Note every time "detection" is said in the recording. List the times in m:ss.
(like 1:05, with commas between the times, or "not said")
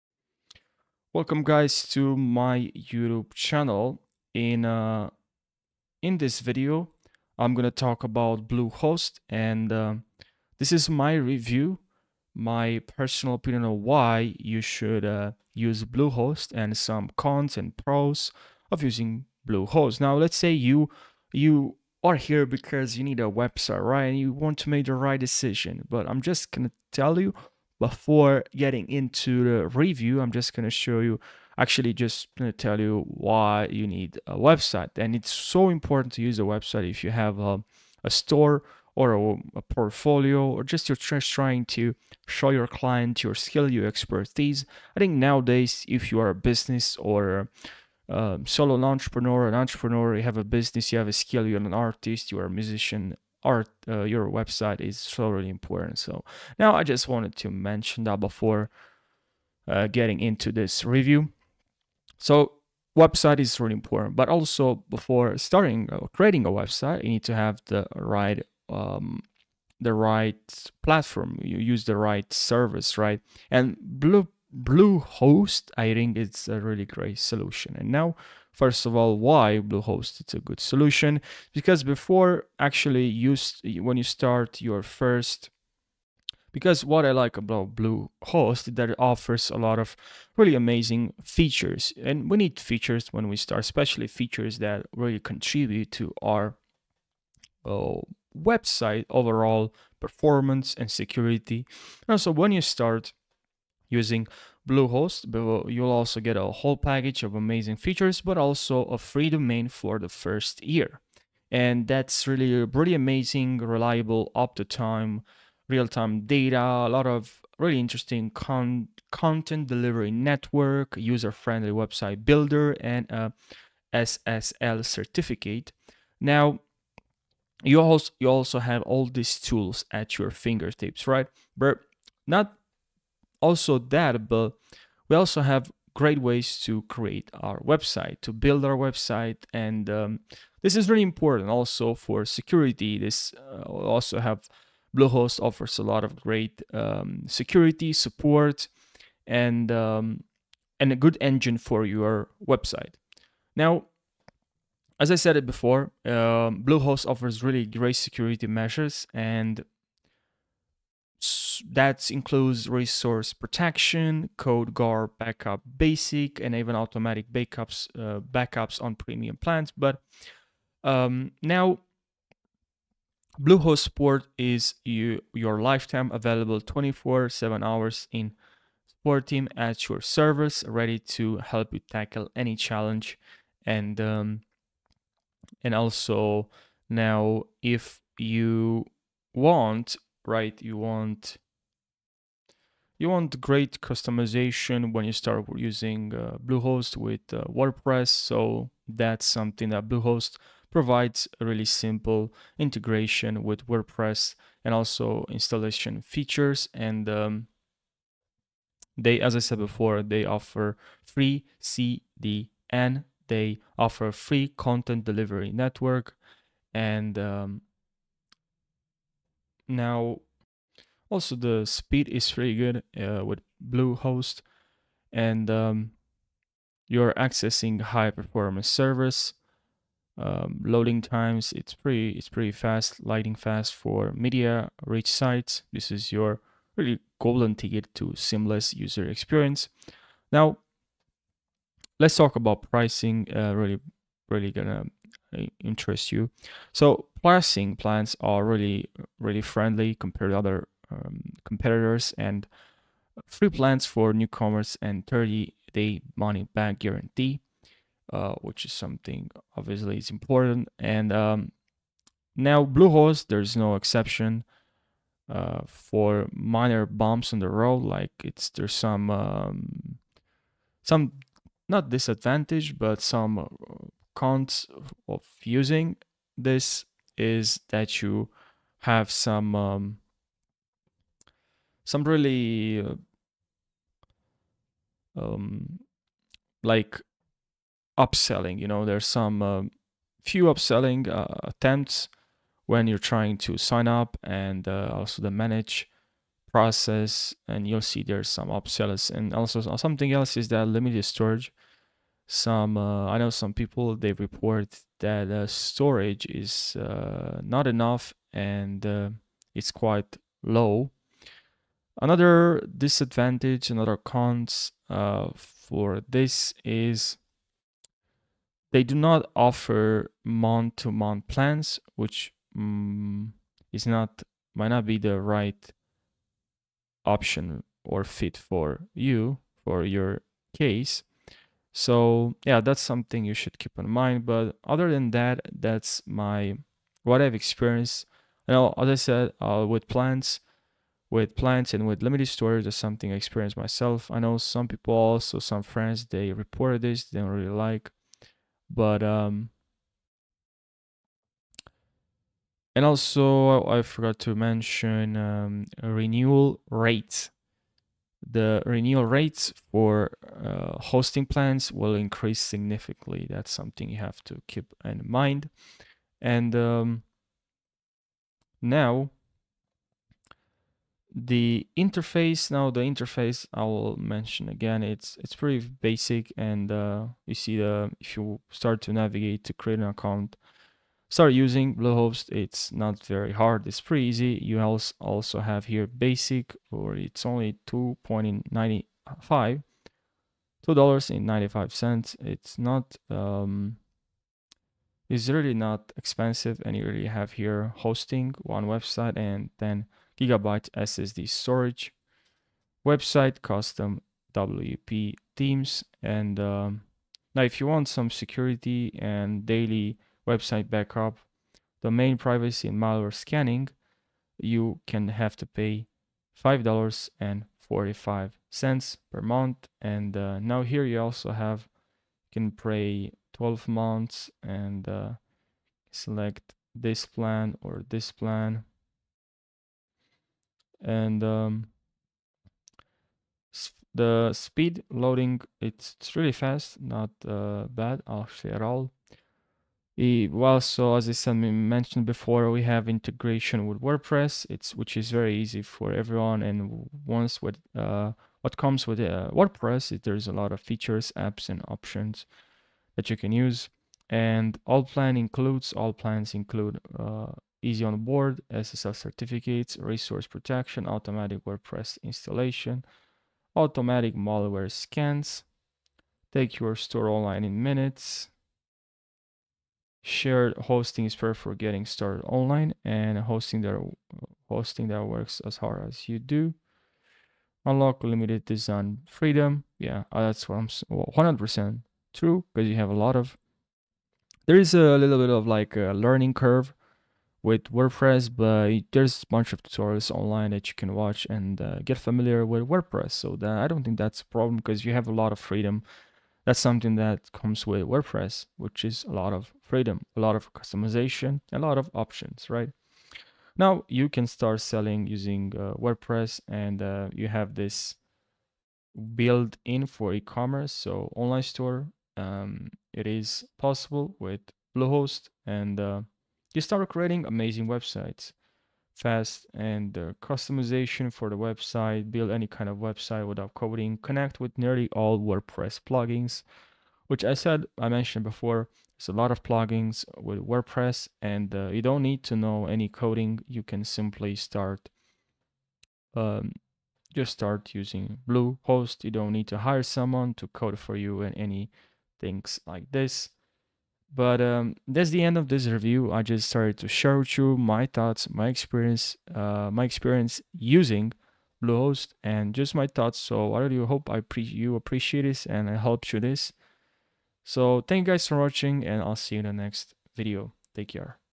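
not said.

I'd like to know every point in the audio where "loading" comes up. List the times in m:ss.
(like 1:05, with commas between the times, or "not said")
3:50, 7:14.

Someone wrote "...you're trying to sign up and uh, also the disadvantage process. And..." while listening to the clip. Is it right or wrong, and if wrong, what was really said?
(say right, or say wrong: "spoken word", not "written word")
wrong: "manage", not "disadvantage".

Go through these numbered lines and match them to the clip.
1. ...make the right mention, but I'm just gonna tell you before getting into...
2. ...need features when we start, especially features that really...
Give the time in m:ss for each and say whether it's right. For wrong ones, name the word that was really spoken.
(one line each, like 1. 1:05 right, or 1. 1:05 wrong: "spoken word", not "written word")
1. 0:24 wrong: "decision", not "mention"
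2. 1:32 right.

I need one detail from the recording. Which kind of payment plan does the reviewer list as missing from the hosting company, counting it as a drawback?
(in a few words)
month-to-month plans.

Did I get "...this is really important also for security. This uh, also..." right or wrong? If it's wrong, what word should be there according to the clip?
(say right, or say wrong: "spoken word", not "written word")
right.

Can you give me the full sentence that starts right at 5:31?
So yeah, that's something you should keep in mind.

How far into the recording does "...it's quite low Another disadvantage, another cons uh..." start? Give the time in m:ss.
5:09.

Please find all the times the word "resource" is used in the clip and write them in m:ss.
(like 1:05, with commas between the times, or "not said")
2:42, 7:39.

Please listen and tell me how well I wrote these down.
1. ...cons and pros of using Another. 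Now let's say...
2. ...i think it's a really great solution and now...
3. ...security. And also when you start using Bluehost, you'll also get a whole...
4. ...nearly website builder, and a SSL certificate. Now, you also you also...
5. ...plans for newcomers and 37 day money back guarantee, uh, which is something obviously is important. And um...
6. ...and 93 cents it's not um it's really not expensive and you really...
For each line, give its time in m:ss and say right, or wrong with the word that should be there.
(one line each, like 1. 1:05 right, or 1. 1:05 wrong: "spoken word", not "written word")
1. 0:17 wrong: "Bluehost", not "Another"
2. 1:15 right
3. 1:40 right
4. 2:01 wrong: "friendly", not "nearly"
5. 4:13 wrong: "30", not "37"
6. 6:31 wrong: "95", not "93".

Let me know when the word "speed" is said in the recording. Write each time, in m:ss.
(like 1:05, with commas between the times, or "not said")
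3:41, 7:14.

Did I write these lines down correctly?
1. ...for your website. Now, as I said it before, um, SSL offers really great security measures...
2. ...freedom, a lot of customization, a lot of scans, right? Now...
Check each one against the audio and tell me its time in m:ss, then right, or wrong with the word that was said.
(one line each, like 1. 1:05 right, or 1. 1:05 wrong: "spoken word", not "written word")
1. 2:31 wrong: "Bluehost", not "SSL"
2. 8:19 wrong: "options", not "scans".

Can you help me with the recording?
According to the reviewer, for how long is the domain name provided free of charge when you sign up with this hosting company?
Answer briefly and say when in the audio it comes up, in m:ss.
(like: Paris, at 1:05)
first year, at 1:49.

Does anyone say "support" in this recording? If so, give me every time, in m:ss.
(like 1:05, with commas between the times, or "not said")
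2:27, 2:53, 2:58.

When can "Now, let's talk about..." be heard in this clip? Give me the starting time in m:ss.
4:00.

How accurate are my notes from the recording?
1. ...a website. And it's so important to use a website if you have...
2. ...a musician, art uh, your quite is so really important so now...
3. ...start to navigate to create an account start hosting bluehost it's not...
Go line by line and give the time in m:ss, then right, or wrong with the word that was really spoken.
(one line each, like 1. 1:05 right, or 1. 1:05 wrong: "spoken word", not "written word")
1. 0:34 right
2. 0:52 wrong: "website", not "quite"
3. 6:18 wrong: "using", not "hosting".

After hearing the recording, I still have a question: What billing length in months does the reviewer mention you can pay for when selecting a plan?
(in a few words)
12 months.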